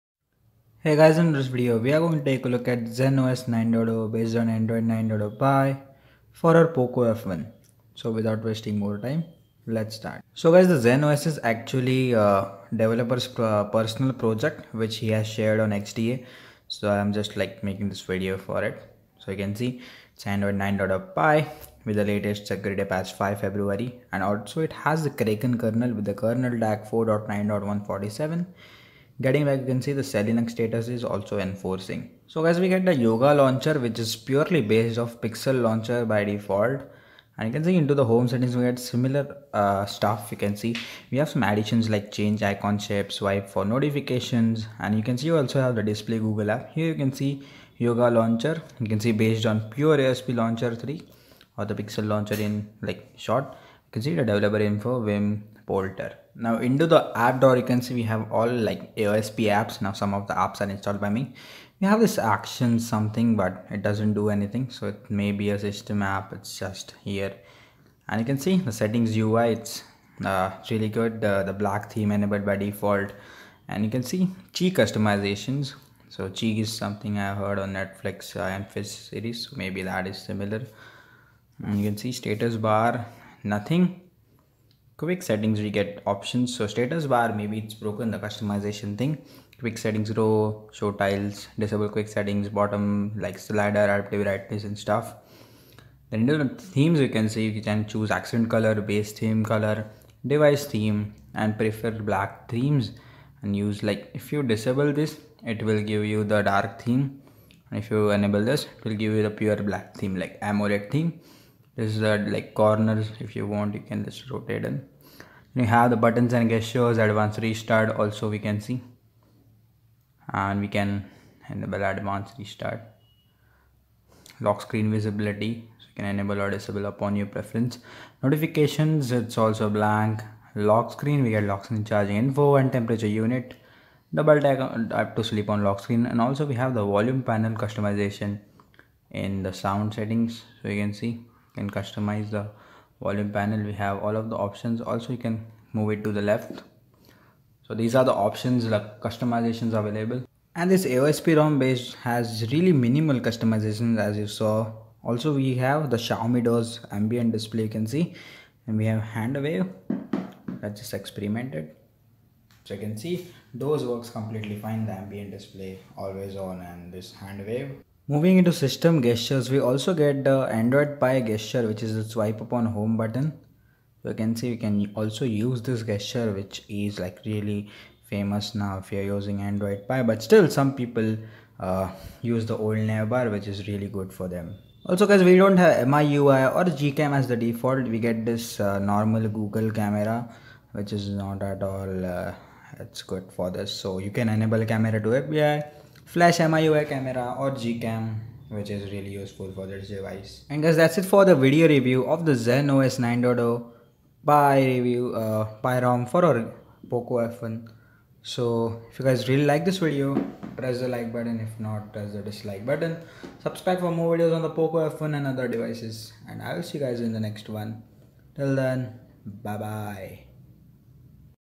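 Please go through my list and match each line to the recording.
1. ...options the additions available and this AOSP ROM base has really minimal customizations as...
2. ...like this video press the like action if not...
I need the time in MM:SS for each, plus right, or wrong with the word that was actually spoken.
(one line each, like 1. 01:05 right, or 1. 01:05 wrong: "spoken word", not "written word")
1. 02:28 wrong: "customizations", not "additions"
2. 03:29 wrong: "button", not "action".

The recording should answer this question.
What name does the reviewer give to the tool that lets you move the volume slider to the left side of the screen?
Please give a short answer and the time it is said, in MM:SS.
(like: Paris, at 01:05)
volume panel customization, at 02:16.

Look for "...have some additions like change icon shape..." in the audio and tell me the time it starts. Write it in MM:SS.
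00:41.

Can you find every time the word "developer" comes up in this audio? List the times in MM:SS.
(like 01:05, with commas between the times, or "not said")
00:12, 00:54.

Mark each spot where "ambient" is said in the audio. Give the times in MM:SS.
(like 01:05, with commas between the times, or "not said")
02:36, 02:44.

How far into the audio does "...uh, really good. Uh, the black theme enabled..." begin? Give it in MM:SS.
01:10.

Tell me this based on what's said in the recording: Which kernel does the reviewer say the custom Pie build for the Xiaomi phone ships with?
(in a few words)
Kraken.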